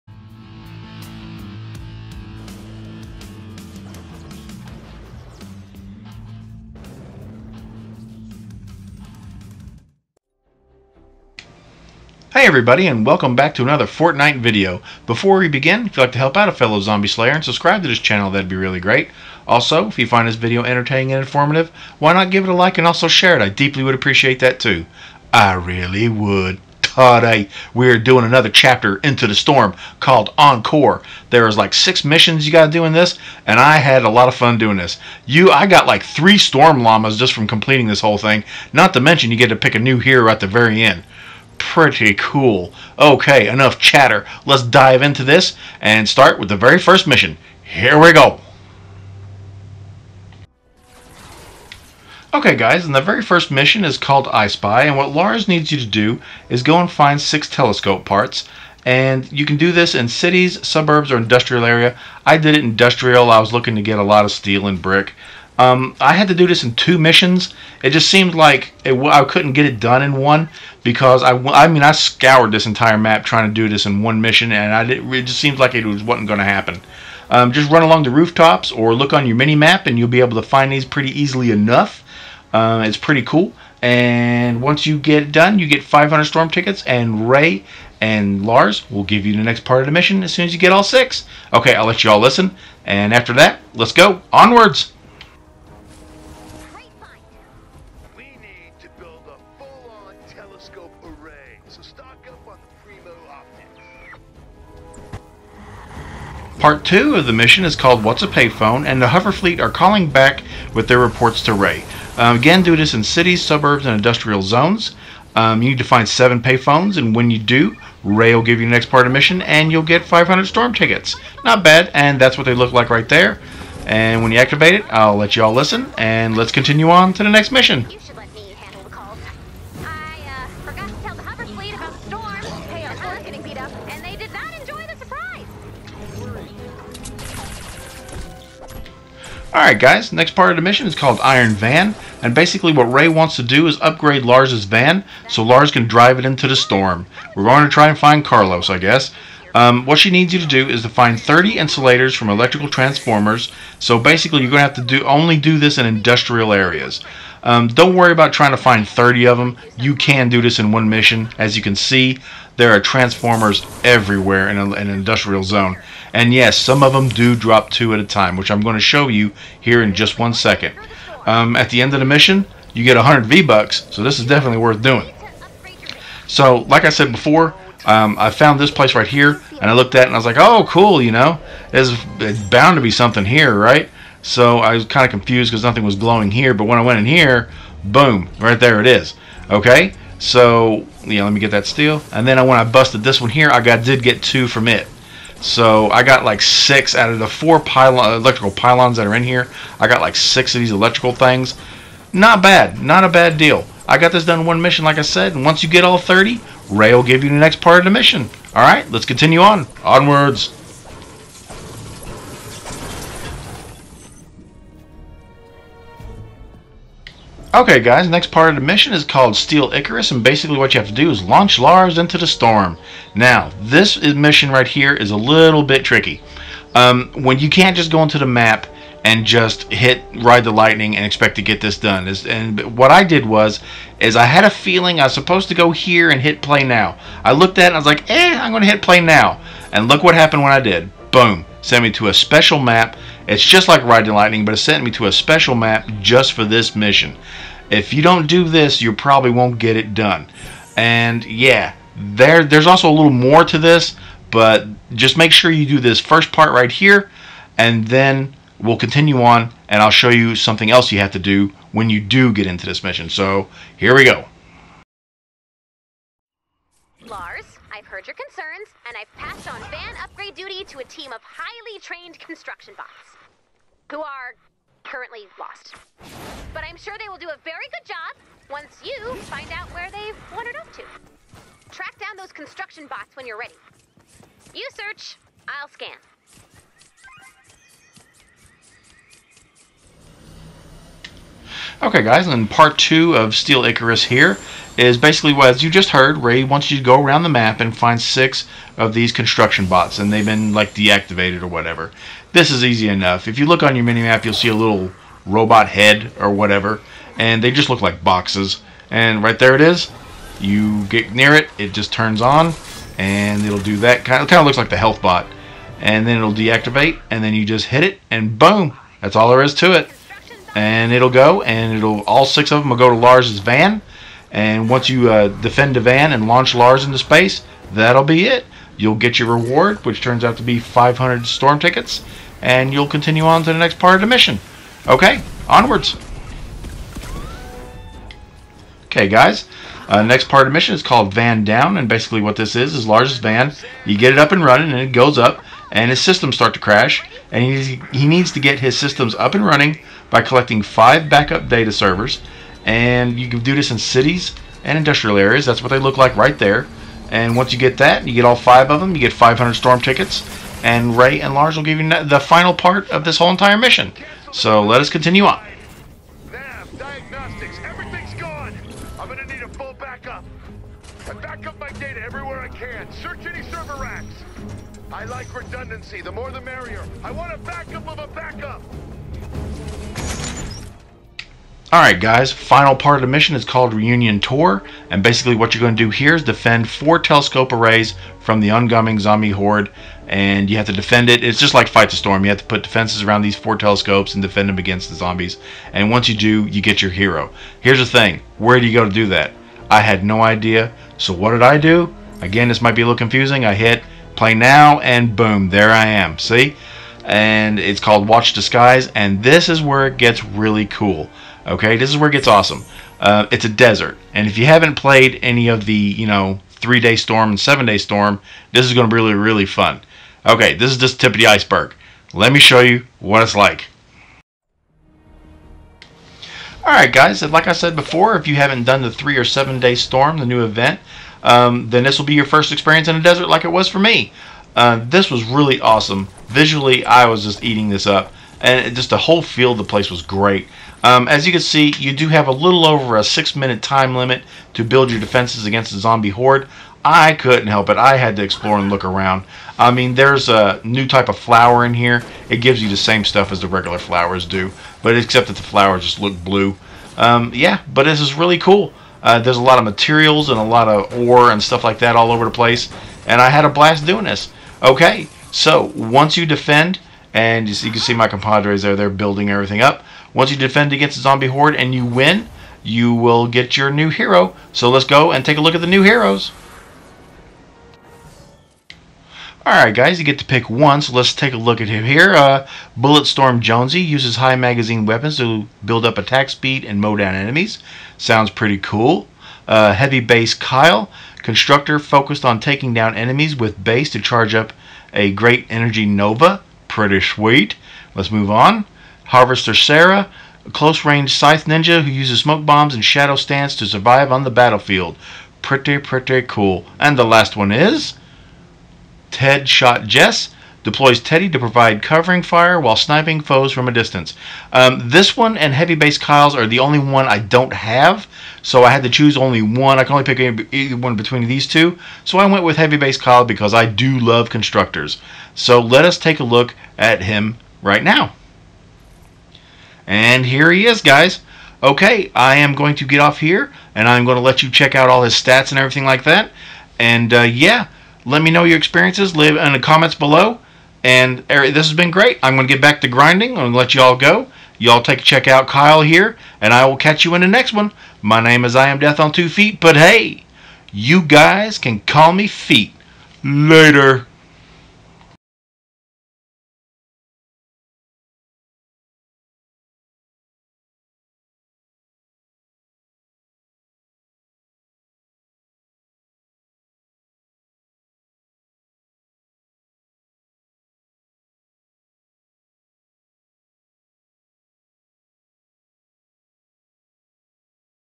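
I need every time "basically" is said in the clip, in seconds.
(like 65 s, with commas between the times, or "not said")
142 s, 153 s, 220 s, 294 s, 341 s, 385 s.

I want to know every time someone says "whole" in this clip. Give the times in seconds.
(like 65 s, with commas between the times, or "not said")
38 s, 363 s, 438 s.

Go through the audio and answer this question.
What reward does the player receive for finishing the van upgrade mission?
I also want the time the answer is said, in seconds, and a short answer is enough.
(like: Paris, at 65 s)
100 V-Bucks, at 172 s.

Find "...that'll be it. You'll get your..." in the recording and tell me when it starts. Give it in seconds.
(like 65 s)
327 s.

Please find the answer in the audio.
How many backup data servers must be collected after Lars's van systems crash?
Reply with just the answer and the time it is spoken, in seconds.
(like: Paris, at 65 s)
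5, at 350 s.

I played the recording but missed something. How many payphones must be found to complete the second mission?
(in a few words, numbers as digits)
7.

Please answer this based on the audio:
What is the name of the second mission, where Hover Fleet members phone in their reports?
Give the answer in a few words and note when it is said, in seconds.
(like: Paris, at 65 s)
What's a Payphone, at 108 s.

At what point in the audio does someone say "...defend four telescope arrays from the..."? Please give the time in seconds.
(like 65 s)
386 s.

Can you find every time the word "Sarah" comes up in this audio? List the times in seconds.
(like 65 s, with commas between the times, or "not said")
499 s.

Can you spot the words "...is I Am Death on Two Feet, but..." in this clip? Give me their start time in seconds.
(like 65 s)
548 s.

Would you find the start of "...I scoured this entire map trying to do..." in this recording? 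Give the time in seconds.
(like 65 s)
71 s.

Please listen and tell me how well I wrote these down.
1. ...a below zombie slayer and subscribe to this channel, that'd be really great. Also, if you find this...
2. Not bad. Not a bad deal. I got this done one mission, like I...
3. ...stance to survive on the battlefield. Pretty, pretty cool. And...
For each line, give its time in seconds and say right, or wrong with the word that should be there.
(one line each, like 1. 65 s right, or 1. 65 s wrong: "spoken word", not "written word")
1. 16 s wrong: "fellow", not "below"
2. 202 s right
3. 503 s right.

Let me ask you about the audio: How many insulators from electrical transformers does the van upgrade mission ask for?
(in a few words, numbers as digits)
30.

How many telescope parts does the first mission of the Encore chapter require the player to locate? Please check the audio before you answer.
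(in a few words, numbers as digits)
6.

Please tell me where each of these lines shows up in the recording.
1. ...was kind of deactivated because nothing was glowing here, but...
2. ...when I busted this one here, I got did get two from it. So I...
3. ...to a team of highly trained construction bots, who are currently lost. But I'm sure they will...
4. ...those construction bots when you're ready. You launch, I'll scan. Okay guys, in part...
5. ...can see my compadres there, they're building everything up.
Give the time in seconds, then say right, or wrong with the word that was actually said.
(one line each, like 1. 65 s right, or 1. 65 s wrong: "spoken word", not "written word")
1. 184 s wrong: "confused", not "deactivated"
2. 192 s right
3. 270 s right
4. 282 s wrong: "search", not "launch"
5. 467 s right.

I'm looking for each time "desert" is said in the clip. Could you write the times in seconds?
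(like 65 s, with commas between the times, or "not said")
413 s, 433 s.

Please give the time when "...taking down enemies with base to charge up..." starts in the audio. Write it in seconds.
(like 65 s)
492 s.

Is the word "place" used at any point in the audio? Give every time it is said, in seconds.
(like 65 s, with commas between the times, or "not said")
178 s, 439 s, 462 s.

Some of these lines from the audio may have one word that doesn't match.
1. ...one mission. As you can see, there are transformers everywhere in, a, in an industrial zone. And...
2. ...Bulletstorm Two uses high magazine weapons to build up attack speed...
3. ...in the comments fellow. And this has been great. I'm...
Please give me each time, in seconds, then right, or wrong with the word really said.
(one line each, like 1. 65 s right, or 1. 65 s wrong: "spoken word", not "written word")
1. 160 s right
2. 482 s wrong: "Jonesy", not "Two"
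3. 539 s wrong: "below", not "fellow".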